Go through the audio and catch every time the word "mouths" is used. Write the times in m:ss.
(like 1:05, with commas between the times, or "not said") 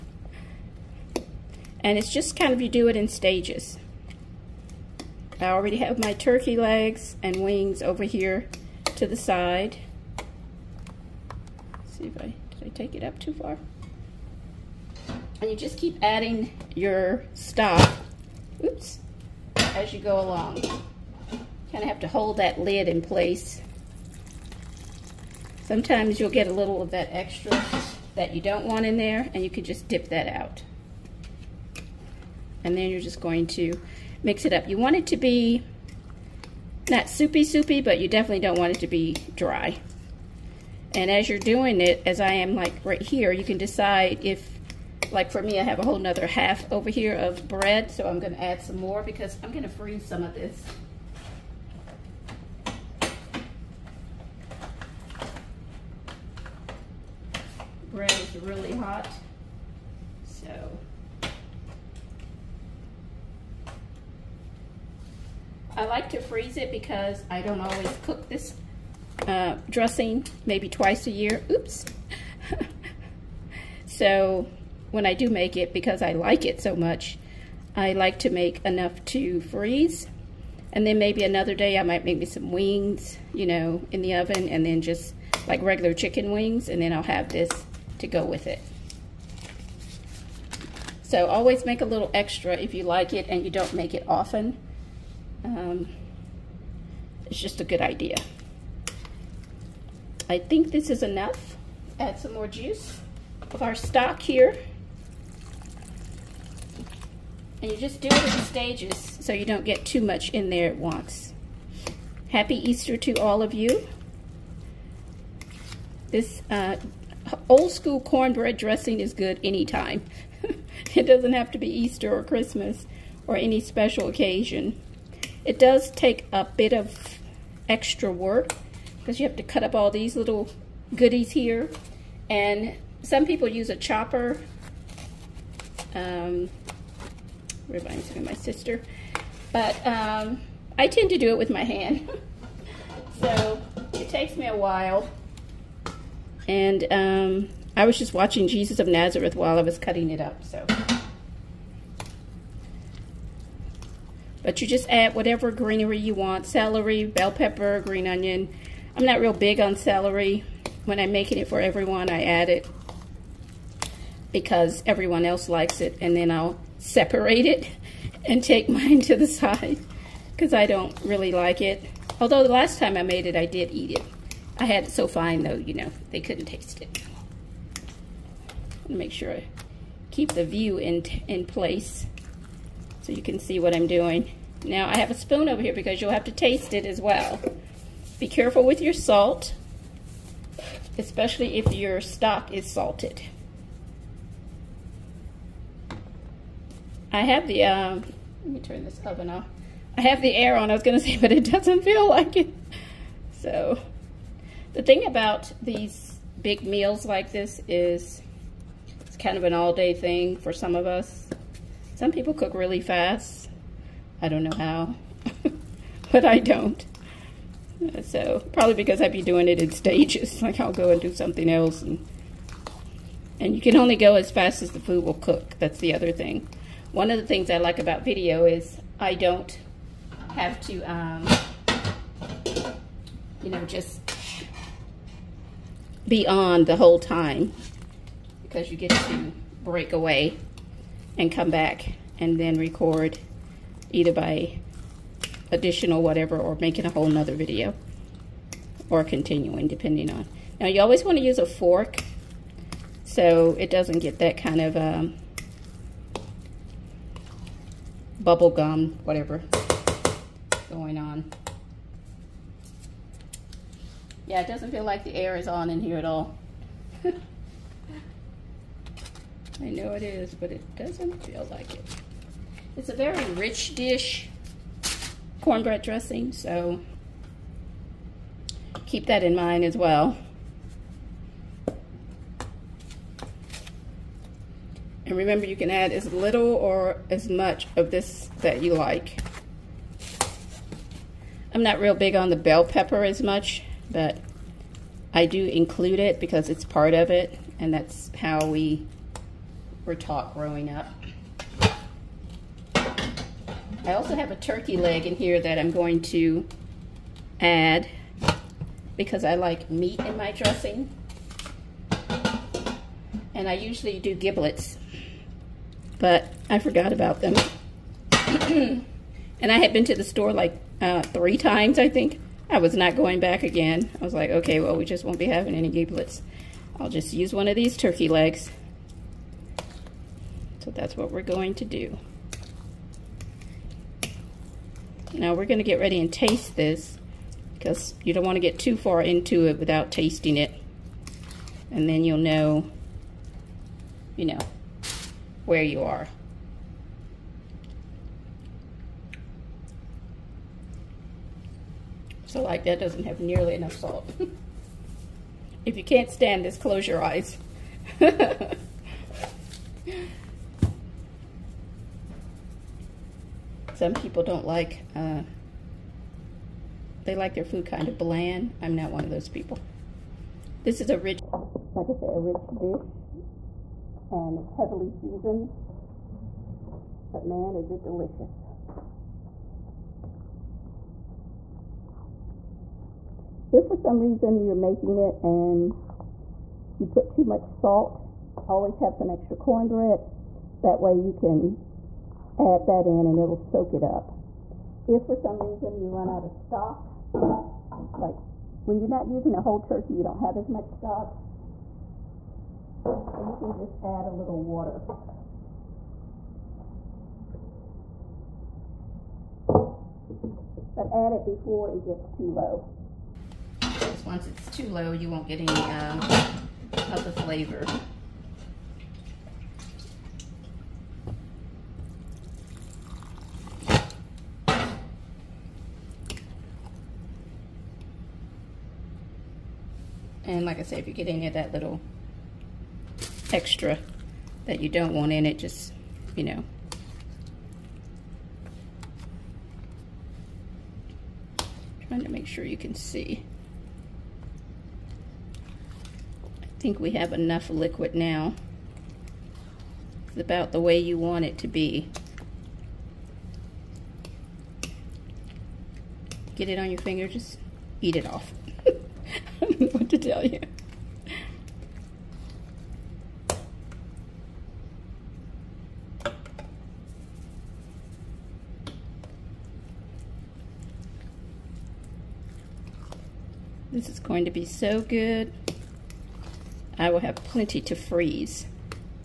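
not said.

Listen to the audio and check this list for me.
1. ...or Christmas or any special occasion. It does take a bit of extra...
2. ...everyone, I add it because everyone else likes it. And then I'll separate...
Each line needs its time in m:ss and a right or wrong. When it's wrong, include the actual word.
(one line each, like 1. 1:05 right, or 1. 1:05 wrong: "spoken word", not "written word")
1. 2:02 right
2. 2:41 right.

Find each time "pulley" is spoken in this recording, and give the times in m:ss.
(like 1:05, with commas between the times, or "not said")
not said.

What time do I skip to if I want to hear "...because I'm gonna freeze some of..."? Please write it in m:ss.
0:49.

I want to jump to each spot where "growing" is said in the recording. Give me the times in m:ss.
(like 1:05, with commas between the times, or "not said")
5:00.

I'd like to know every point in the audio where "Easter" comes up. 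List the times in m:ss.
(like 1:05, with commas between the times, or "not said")
1:52, 2:01.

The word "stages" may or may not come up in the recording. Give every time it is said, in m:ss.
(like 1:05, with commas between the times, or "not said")
0:03, 1:48, 3:39.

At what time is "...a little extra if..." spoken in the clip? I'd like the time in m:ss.
1:31.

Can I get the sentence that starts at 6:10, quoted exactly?
This is a rich, like I say, a rich dish and it's heavily seasoned.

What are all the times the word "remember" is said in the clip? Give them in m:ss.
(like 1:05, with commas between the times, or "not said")
4:45.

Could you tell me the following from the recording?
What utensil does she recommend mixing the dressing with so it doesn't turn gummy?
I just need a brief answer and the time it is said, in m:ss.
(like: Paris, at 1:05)
fork, at 4:11.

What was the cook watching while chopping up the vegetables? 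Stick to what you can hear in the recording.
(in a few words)
Jesus of Nazareth.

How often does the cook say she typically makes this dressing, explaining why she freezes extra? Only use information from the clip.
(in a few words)
twice a year.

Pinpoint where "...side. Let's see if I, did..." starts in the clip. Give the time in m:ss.
0:09.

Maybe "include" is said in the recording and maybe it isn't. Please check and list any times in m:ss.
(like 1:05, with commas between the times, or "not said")
4:55.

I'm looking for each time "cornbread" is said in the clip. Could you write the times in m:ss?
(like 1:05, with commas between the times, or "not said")
1:57, 4:35, 6:29.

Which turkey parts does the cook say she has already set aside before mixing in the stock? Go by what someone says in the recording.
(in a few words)
legs and wings.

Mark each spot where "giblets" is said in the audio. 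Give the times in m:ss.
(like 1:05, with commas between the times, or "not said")
5:14, 5:25.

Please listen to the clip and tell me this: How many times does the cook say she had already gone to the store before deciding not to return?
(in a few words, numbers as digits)
3.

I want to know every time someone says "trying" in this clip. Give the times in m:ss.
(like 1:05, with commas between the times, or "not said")
7:21.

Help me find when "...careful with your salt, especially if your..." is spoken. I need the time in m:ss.
3:08.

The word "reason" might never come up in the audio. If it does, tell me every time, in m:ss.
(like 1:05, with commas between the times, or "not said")
6:23, 6:35.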